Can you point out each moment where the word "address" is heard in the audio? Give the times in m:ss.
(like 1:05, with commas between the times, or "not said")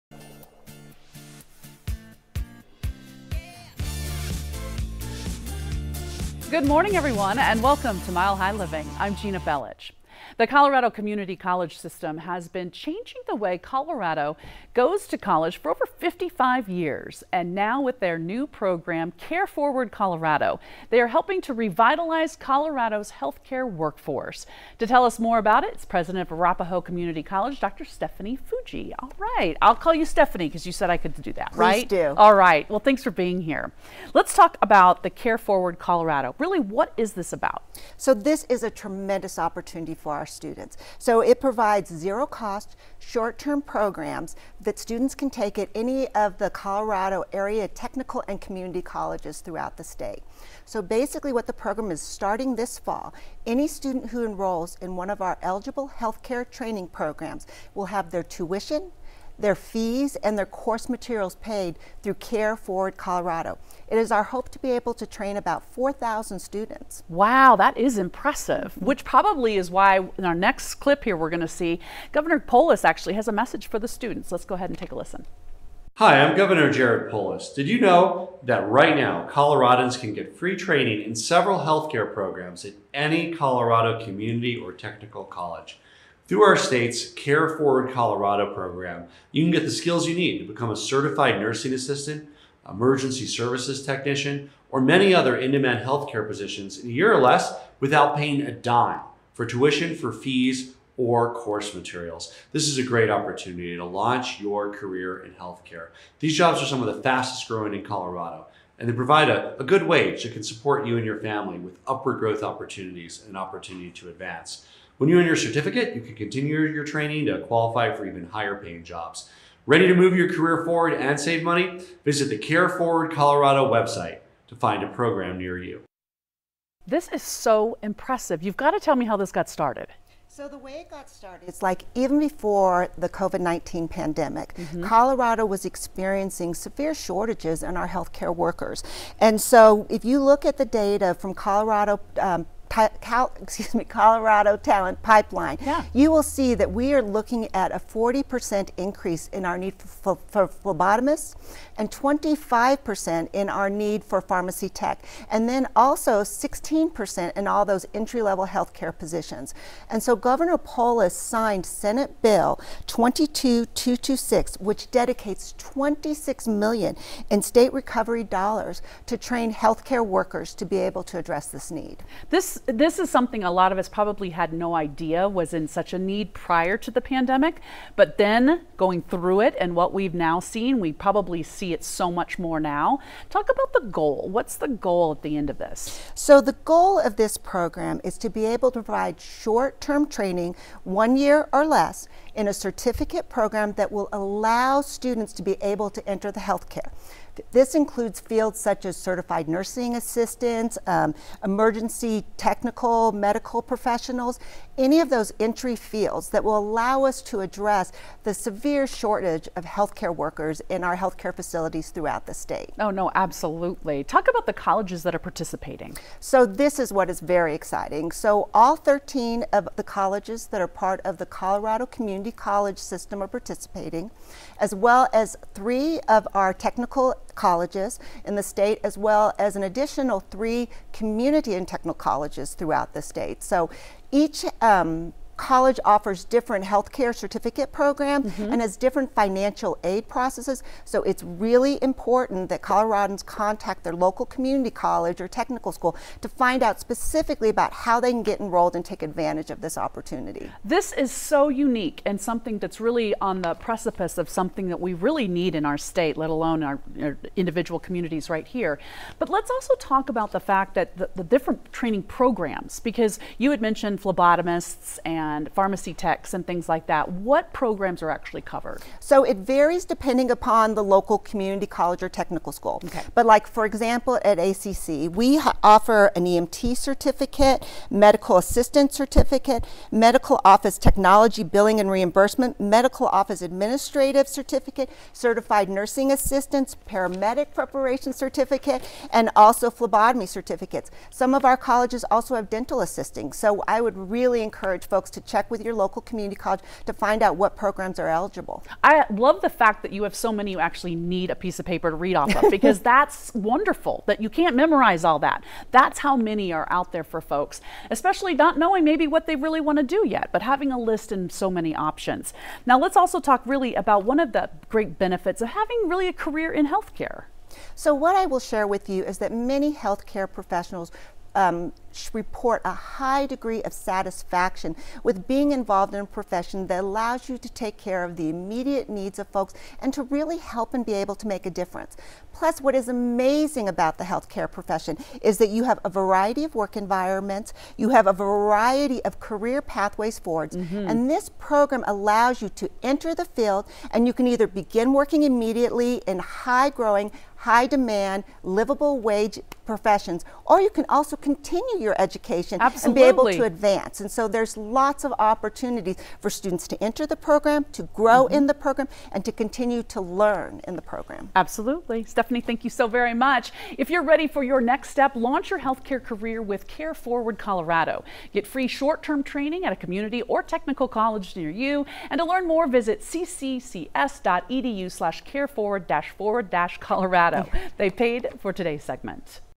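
2:51, 3:27.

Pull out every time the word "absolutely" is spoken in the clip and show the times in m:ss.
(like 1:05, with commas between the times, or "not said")
3:33, 5:52, 6:01.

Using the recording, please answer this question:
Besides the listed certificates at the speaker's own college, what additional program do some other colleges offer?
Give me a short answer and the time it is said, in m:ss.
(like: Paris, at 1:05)
dental assisting, at 4:52.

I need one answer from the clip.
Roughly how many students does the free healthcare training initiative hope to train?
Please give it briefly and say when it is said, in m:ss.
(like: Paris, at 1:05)
4,000, at 1:05.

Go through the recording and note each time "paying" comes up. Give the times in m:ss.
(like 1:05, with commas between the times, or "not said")
1:38, 1:58.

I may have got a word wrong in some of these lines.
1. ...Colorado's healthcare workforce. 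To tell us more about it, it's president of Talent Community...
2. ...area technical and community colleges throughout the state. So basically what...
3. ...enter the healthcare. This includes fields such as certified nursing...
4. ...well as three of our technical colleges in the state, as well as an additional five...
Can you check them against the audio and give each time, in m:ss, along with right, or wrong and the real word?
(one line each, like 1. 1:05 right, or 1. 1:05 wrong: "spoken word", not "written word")
1. 0:22 wrong: "Arapahoe", not "Talent"
2. 0:47 right
3. 3:16 right
4. 3:44 wrong: "three", not "five".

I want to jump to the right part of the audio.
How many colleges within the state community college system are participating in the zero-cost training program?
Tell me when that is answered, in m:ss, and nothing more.
3:38.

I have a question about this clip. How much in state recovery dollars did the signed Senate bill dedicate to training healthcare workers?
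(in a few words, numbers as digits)
26 million.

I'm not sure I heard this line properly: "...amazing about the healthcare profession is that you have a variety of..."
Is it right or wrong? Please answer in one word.
right.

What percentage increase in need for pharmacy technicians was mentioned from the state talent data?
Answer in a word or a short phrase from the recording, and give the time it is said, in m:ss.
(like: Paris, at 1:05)
25%, at 2:31.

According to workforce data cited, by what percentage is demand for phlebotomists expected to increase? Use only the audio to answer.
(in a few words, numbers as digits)
40%.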